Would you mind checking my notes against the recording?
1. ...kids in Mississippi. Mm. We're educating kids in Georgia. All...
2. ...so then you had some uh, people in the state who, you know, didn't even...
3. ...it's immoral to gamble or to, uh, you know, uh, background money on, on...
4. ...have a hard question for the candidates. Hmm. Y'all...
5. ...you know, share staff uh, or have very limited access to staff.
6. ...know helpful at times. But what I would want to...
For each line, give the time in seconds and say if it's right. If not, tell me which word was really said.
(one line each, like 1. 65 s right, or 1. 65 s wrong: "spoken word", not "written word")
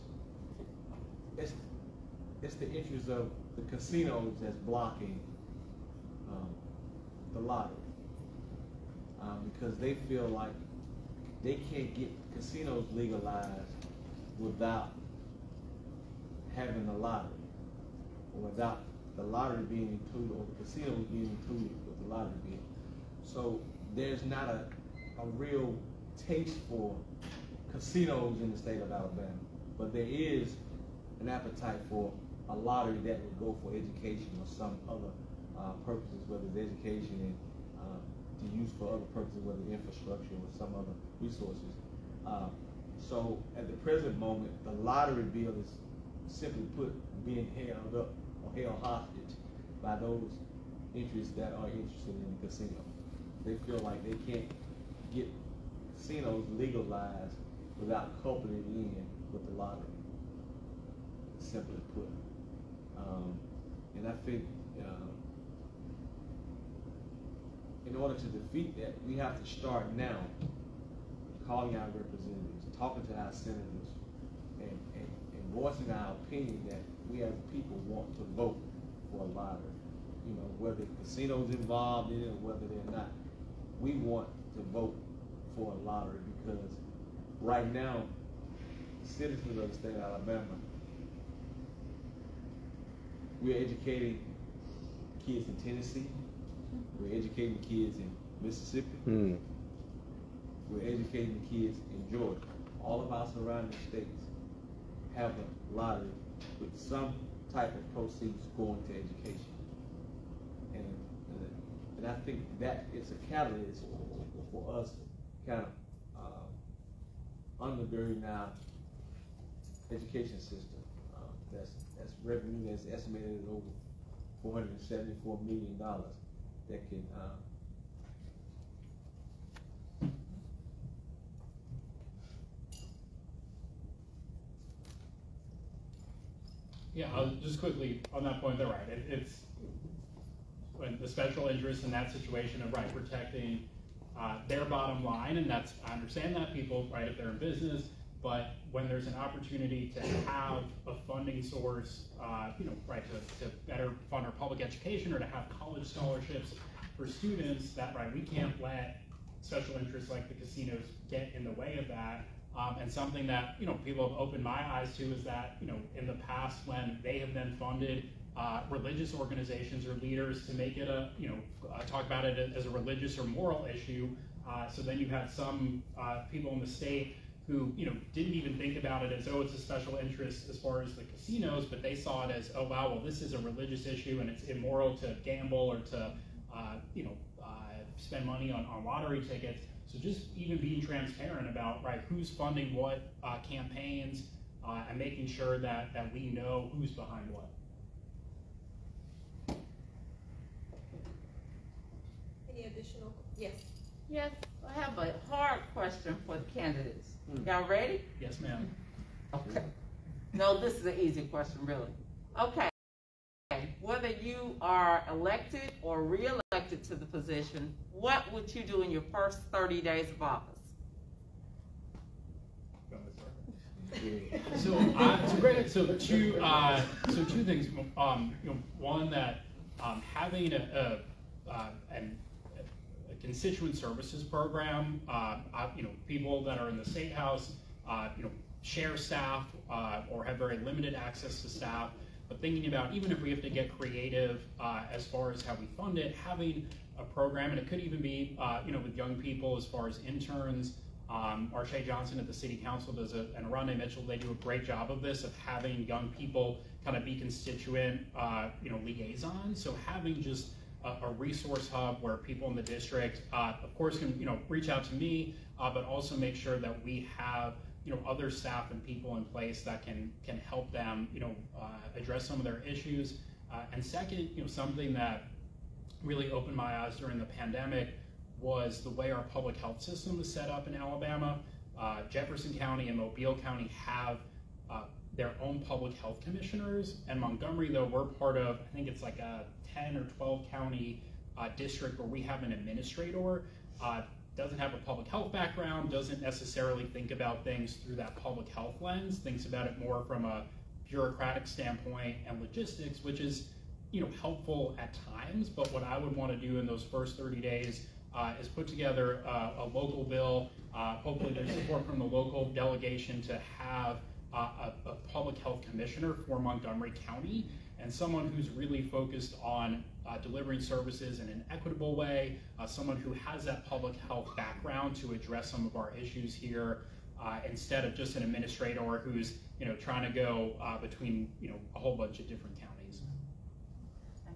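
1. 97 s right
2. 174 s right
3. 184 s wrong: "spend", not "background"
4. 204 s right
5. 238 s right
6. 304 s right.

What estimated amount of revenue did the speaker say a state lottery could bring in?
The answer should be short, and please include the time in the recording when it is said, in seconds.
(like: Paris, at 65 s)
over $474 million, at 123 s.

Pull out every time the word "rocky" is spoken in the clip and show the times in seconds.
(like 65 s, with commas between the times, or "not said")
not said.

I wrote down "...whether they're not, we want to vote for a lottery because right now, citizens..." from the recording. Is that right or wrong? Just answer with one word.
right.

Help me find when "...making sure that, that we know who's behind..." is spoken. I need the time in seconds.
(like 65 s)
194 s.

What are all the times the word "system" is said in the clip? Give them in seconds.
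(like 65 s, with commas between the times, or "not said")
120 s, 279 s.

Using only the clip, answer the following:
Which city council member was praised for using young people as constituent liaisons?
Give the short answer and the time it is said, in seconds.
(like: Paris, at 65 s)
Marche Johnson, at 251 s.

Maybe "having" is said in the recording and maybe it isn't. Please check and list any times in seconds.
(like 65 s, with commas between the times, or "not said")
16 s, 230 s, 246 s, 255 s, 259 s.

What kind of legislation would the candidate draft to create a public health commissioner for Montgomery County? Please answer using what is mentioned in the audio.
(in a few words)
a local bill.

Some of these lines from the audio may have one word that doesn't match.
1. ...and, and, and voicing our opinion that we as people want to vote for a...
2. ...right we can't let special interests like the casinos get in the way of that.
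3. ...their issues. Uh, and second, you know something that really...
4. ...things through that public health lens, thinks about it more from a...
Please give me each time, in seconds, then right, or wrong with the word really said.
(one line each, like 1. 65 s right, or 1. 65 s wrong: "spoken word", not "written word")
1. 74 s right
2. 157 s right
3. 272 s right
4. 297 s right.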